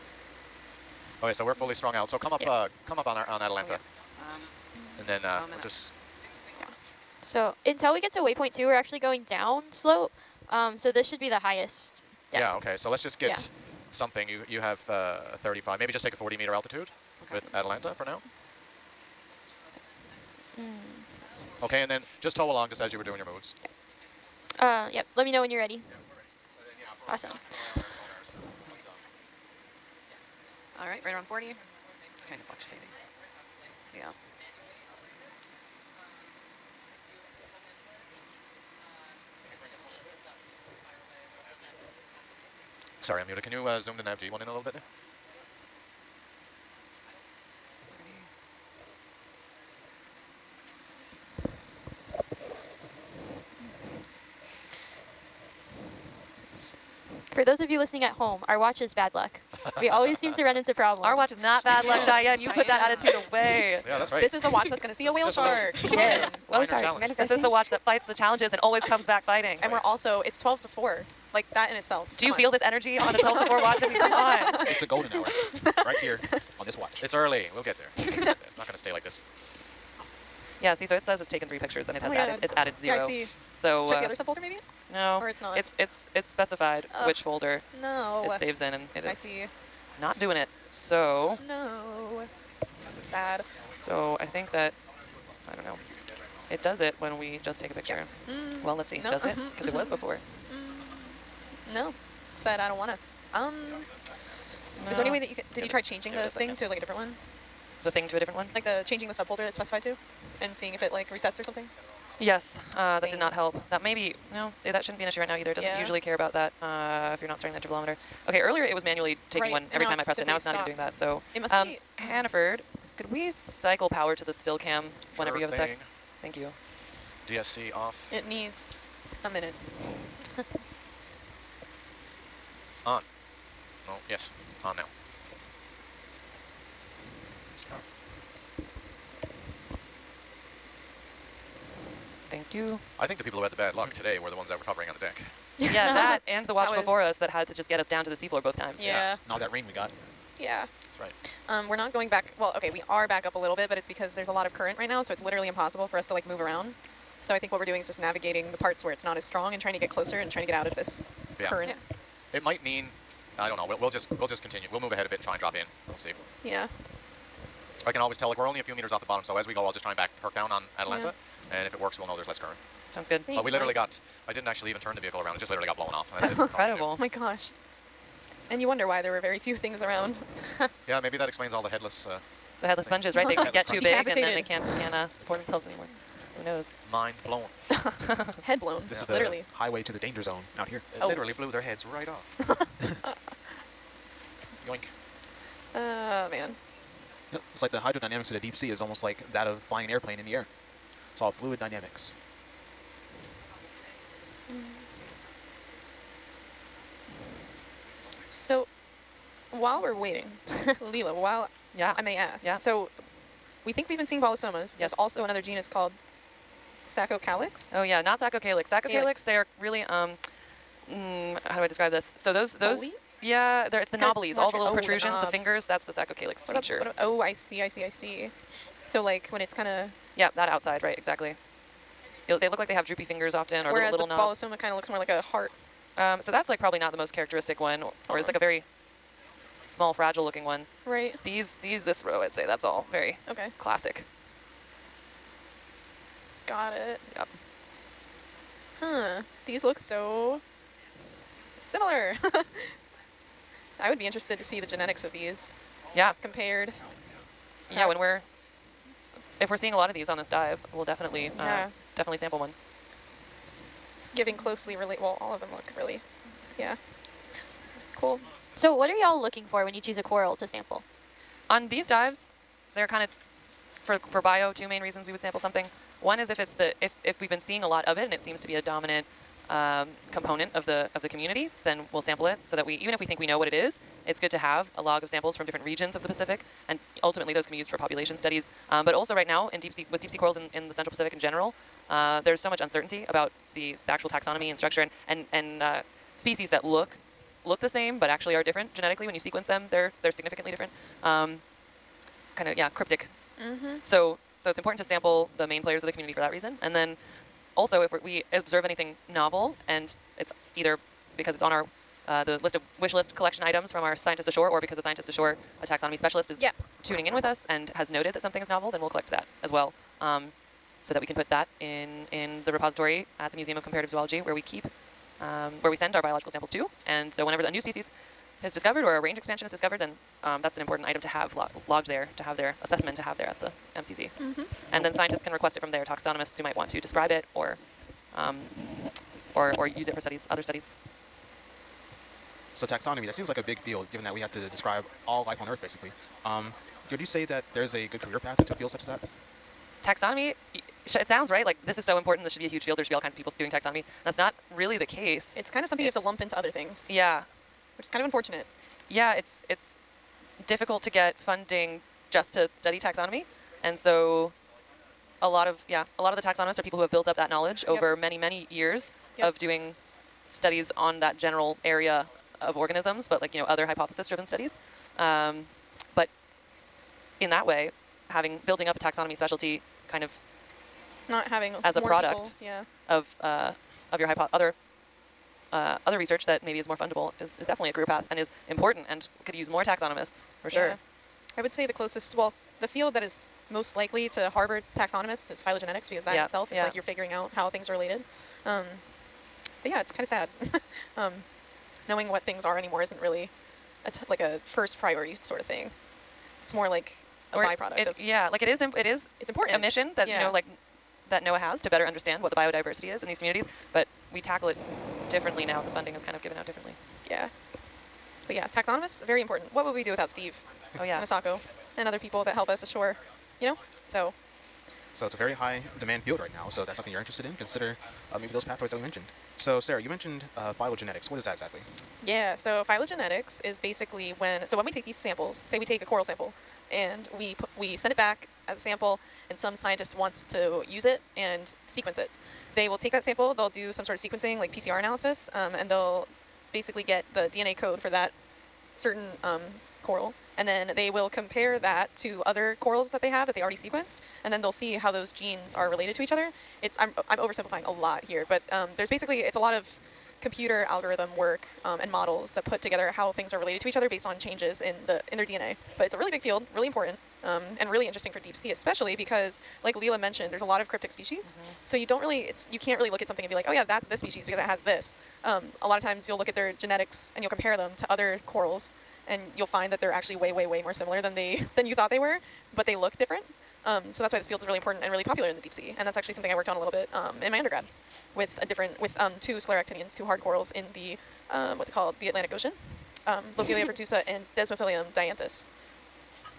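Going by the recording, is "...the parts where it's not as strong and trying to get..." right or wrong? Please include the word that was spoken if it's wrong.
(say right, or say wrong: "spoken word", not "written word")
right.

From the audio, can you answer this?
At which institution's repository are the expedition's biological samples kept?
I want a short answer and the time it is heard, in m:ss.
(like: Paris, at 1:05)
Museum of Comparative Zoology, at 5:23.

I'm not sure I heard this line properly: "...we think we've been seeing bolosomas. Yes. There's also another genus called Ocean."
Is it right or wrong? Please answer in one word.
wrong.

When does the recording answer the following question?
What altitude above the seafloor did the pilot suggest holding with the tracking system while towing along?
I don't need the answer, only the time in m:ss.
0:16.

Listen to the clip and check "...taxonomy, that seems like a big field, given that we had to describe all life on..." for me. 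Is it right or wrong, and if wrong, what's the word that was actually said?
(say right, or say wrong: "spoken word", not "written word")
right.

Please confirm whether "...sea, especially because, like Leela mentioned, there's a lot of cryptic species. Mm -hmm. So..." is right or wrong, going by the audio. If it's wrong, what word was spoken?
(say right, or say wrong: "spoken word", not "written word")
right.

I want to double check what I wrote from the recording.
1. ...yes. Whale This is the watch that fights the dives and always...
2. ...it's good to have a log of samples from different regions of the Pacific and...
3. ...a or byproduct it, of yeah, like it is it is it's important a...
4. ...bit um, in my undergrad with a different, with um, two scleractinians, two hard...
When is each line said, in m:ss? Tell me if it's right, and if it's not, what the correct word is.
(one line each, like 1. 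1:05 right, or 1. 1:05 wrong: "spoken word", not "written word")
1. 1:05 wrong: "challenges", not "dives"
2. 4:44 right
3. 6:47 right
4. 8:06 right.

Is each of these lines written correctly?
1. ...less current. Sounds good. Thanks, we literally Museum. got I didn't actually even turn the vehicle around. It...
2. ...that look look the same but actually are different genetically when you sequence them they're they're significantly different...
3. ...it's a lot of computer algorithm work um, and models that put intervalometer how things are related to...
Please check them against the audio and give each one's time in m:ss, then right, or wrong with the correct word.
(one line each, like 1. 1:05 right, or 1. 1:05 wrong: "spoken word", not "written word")
1. 2:52 wrong: "Mike", not "Museum"
2. 4:56 right
3. 7:39 wrong: "together", not "intervalometer".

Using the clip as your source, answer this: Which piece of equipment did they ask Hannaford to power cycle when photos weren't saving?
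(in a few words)
Still cam.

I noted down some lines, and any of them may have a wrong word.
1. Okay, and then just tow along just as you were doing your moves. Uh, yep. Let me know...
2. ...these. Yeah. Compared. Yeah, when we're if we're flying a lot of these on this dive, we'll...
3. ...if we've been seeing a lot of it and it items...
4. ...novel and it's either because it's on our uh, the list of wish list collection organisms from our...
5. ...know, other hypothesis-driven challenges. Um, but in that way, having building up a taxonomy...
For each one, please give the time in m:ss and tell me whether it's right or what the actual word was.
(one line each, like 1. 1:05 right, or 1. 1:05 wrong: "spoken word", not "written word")
1. 0:21 right
2. 4:15 wrong: "seeing", not "flying"
3. 4:37 wrong: "seems", not "items"
4. 5:09 wrong: "items", not "organisms"
5. 6:13 wrong: "studies", not "challenges".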